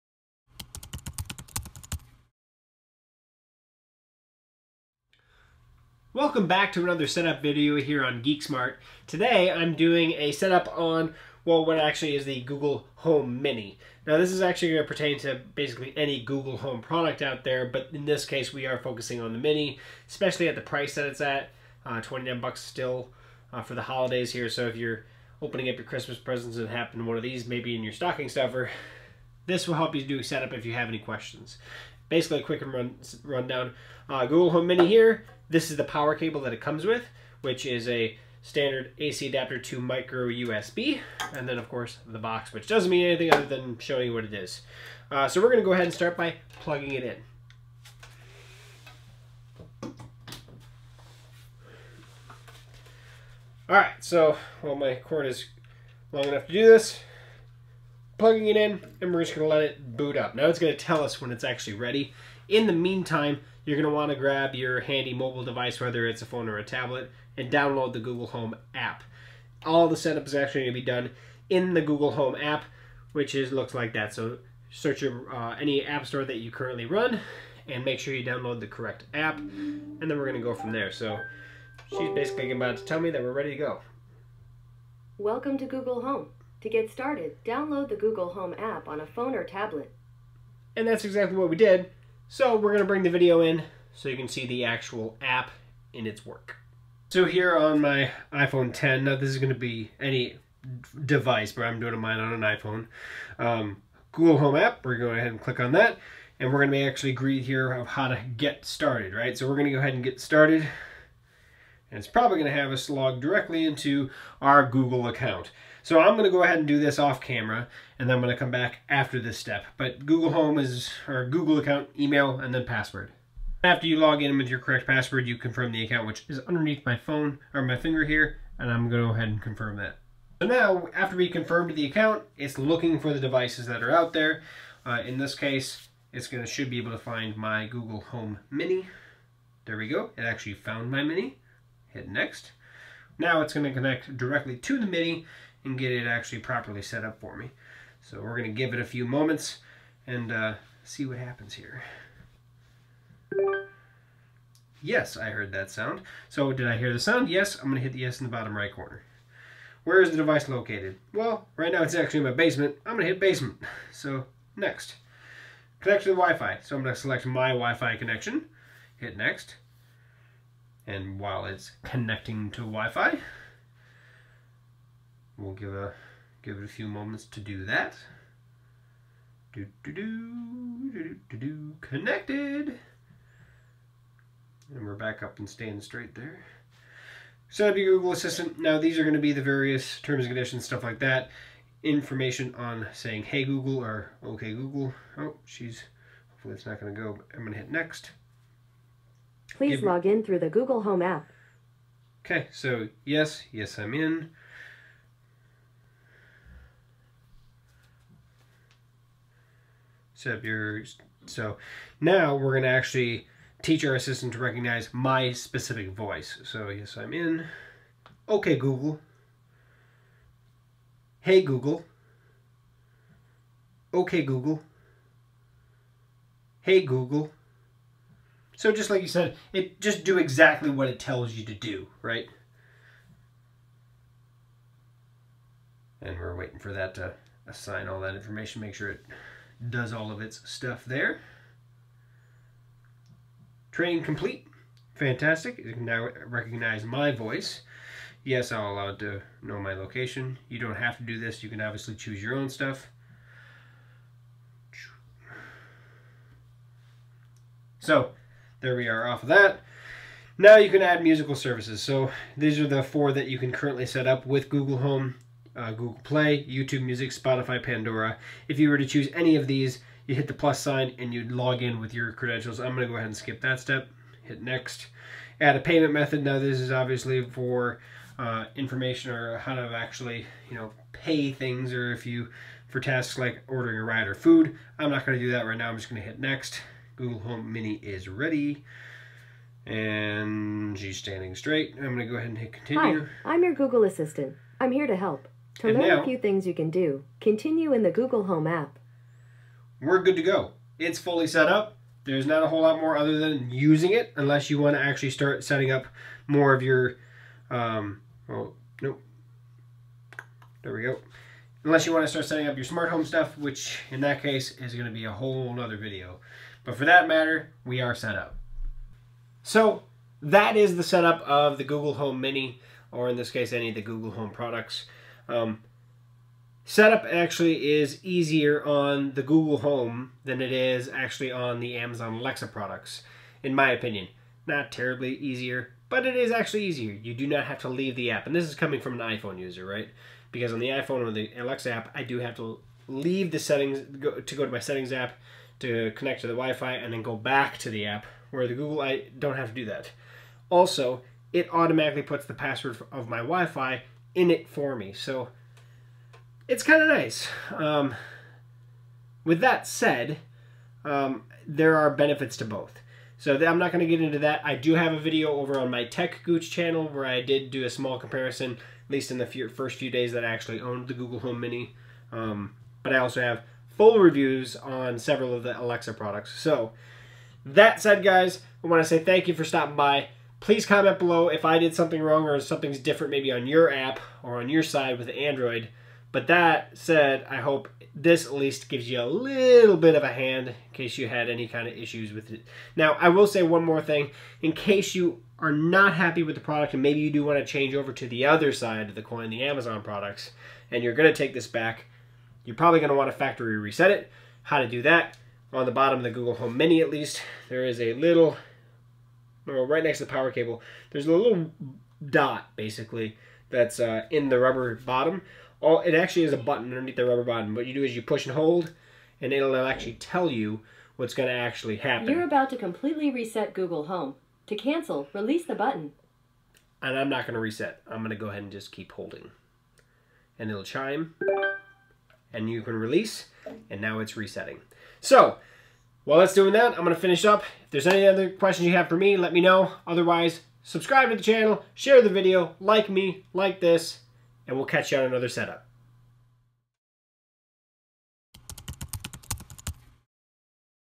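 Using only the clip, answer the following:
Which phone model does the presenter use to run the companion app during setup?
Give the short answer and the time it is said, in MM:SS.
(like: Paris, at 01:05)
iPhone 10, at 01:38.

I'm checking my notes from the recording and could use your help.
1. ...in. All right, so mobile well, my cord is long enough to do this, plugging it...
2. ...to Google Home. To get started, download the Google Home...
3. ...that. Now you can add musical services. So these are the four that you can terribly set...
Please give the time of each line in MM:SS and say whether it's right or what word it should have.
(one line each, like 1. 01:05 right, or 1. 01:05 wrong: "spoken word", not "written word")
1. 00:47 wrong: "while", not "mobile"
2. 01:25 right
3. 04:19 wrong: "currently", not "terribly".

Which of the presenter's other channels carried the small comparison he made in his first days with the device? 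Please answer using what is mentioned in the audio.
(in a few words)
Tech Gooch.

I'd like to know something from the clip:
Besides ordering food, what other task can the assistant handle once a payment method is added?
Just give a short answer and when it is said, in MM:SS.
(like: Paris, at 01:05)
A ride, at 04:43.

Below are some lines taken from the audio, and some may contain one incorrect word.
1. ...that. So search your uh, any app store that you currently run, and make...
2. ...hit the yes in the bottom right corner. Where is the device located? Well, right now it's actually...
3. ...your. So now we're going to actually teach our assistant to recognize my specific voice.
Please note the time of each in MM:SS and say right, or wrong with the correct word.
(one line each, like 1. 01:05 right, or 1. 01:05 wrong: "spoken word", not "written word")
1. 01:13 right
2. 02:37 right
3. 03:30 right.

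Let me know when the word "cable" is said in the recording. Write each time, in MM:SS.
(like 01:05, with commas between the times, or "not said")
00:36, 06:50.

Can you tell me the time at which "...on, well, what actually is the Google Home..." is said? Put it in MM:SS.
00:10.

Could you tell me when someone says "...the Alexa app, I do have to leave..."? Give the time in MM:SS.
05:41.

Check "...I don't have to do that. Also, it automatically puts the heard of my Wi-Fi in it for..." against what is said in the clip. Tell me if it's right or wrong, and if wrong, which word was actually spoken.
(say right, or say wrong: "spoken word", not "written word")
wrong: "password", not "heard".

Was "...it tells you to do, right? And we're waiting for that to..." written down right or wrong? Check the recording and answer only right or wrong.
right.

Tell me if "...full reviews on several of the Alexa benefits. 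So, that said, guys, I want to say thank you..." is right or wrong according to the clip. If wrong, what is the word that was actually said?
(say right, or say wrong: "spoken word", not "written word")
wrong: "products", not "benefits".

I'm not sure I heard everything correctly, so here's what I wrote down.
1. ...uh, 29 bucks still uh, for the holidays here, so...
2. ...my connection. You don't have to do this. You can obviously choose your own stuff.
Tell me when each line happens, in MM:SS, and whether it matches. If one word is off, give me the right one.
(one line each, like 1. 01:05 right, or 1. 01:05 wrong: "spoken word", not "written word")
1. 00:21 right
2. 04:09 wrong: "location", not "connection".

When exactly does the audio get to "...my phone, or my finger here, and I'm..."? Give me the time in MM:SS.
02:06.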